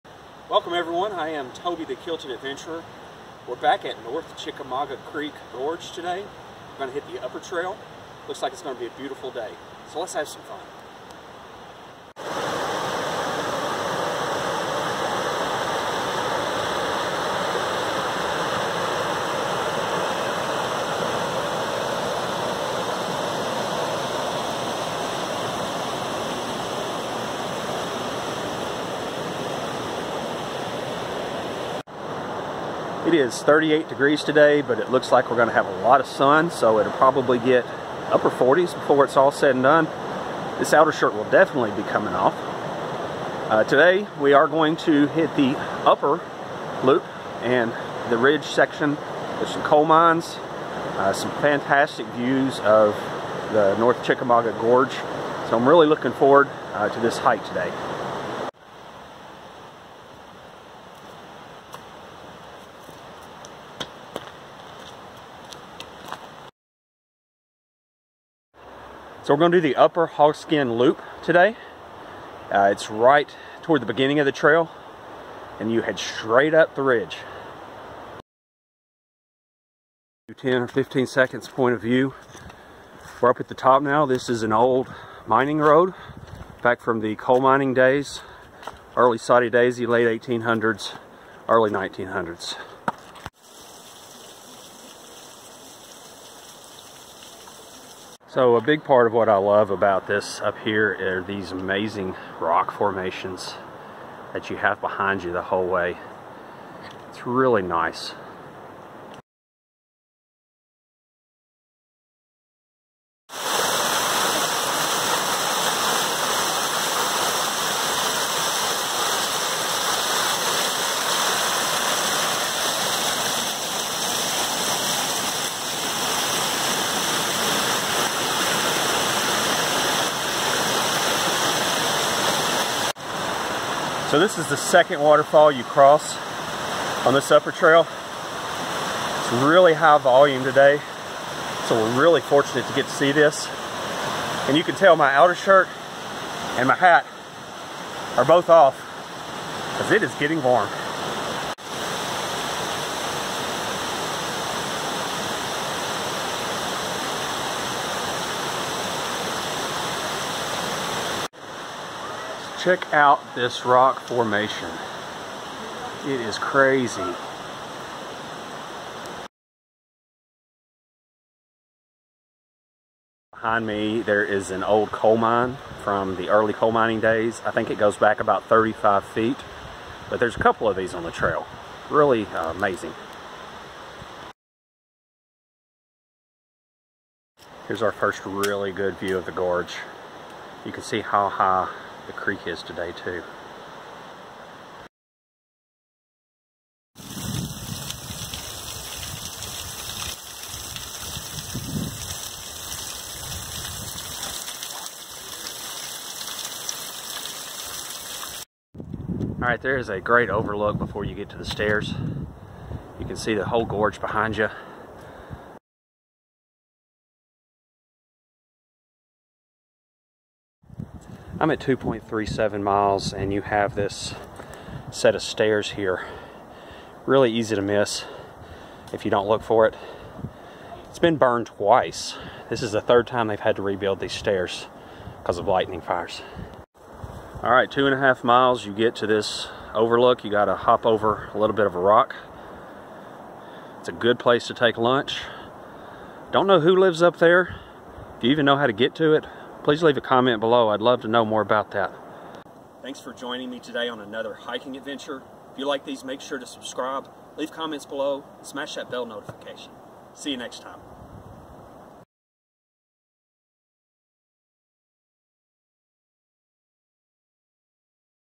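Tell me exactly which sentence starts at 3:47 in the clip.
Really easy to miss if you don't look for it.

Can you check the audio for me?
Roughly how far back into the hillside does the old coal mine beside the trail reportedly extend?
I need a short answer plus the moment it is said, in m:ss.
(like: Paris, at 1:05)
35 feet, at 2:58.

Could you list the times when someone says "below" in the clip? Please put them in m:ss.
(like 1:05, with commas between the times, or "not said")
4:10, 4:17.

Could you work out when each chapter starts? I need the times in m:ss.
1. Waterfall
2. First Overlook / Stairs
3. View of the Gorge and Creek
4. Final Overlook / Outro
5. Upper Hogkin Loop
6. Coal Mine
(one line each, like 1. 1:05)
1. 1:53
2. 3:30
3. 3:07
4. 3:57
5. 1:07
6. 2:53.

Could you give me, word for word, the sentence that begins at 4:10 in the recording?
I'd love to know more about that.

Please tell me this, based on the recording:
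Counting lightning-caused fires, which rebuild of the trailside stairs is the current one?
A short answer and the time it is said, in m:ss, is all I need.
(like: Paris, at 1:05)
third time, at 3:52.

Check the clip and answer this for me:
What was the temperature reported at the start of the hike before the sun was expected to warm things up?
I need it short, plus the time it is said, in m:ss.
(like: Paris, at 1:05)
38 degrees, at 0:33.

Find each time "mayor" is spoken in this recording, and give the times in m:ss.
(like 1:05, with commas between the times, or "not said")
not said.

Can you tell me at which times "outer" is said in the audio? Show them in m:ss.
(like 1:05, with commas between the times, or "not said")
0:40, 2:25.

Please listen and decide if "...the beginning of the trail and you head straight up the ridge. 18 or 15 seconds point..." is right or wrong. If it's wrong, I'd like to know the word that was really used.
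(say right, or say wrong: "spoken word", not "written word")
wrong: "10", not "18".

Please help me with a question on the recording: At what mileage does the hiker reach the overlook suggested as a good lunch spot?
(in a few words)
2.5 miles.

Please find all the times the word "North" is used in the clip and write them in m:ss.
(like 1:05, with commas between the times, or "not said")
0:04, 0:53.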